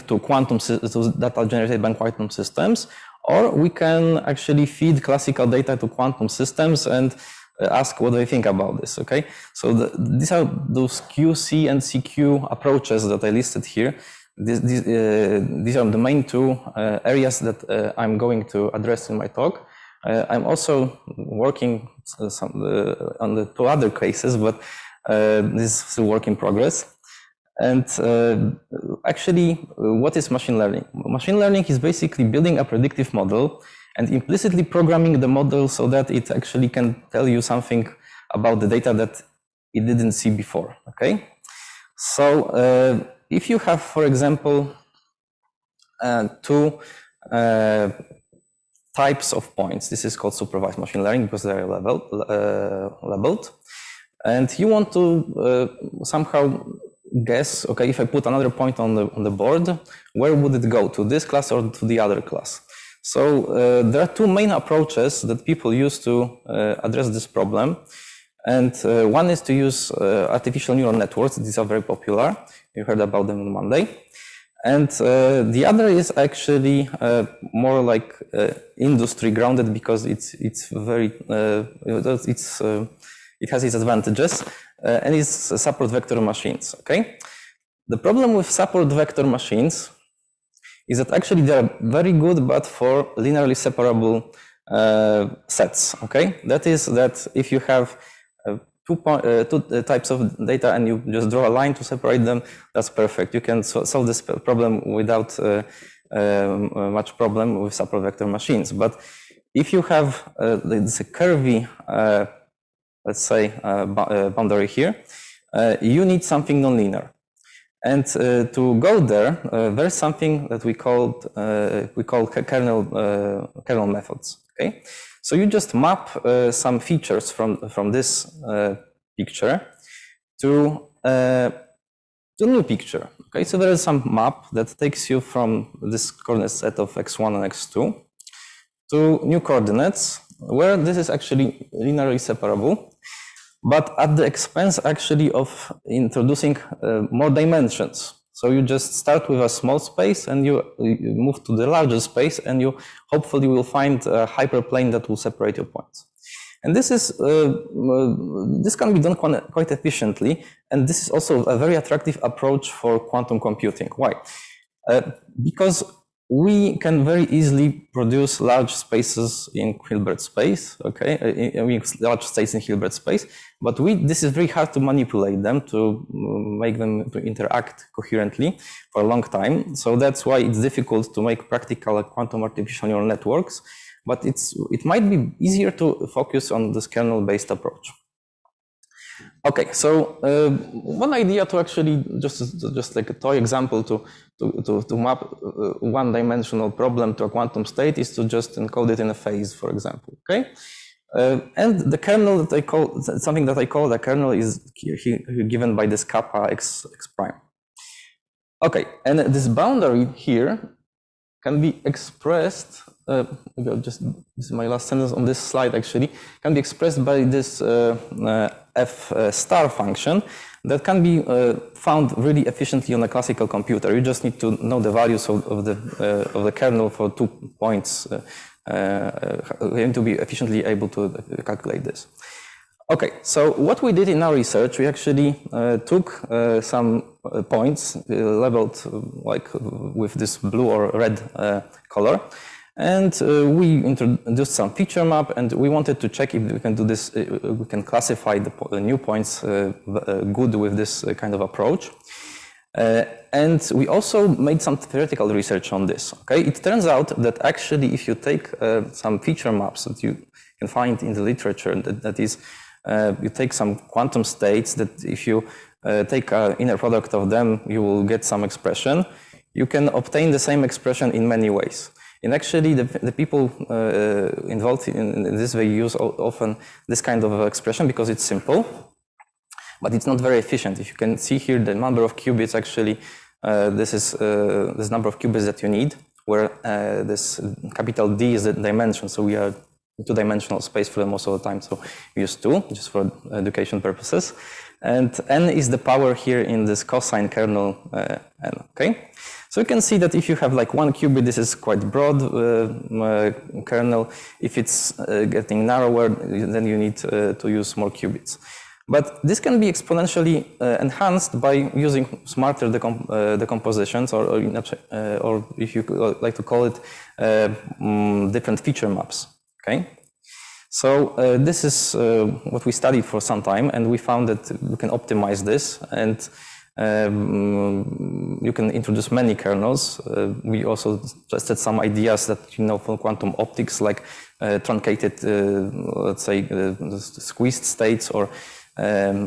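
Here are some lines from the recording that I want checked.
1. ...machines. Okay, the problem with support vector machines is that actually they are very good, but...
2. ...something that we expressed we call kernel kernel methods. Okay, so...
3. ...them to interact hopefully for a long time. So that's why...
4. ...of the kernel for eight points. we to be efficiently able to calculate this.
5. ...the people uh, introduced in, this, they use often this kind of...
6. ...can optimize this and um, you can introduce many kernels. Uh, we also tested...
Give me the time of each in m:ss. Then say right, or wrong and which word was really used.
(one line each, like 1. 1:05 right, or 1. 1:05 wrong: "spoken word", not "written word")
1. 1:26 right
2. 1:59 wrong: "called", not "expressed"
3. 2:56 wrong: "coherently", not "hopefully"
4. 3:46 wrong: "two", not "eight"
5. 4:32 wrong: "involved", not "introduced"
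6. 5:24 right.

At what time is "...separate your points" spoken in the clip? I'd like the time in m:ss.
2:35.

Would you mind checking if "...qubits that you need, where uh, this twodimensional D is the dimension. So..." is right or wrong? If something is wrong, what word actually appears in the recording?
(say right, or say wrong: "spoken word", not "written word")
wrong: "capital", not "twodimensional".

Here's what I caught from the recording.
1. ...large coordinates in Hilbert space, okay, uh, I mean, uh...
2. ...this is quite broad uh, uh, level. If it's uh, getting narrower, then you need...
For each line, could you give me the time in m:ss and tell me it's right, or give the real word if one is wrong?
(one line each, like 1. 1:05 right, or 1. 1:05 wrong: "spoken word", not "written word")
1. 2:48 wrong: "spaces", not "coordinates"
2. 5:01 wrong: "kernel", not "level".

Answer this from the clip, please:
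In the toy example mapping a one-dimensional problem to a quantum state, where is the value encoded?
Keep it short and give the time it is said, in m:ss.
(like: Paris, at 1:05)
in a phase, at 3:18.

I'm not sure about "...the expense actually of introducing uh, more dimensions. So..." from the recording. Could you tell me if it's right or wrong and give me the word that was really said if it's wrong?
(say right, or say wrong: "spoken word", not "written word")
right.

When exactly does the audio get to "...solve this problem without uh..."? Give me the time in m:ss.
1:43.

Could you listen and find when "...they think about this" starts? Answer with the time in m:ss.
0:08.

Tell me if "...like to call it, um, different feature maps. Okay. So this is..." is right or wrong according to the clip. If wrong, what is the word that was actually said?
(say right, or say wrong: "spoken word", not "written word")
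right.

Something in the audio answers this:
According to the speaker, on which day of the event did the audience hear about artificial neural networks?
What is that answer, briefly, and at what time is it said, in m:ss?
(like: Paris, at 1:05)
Monday, at 1:13.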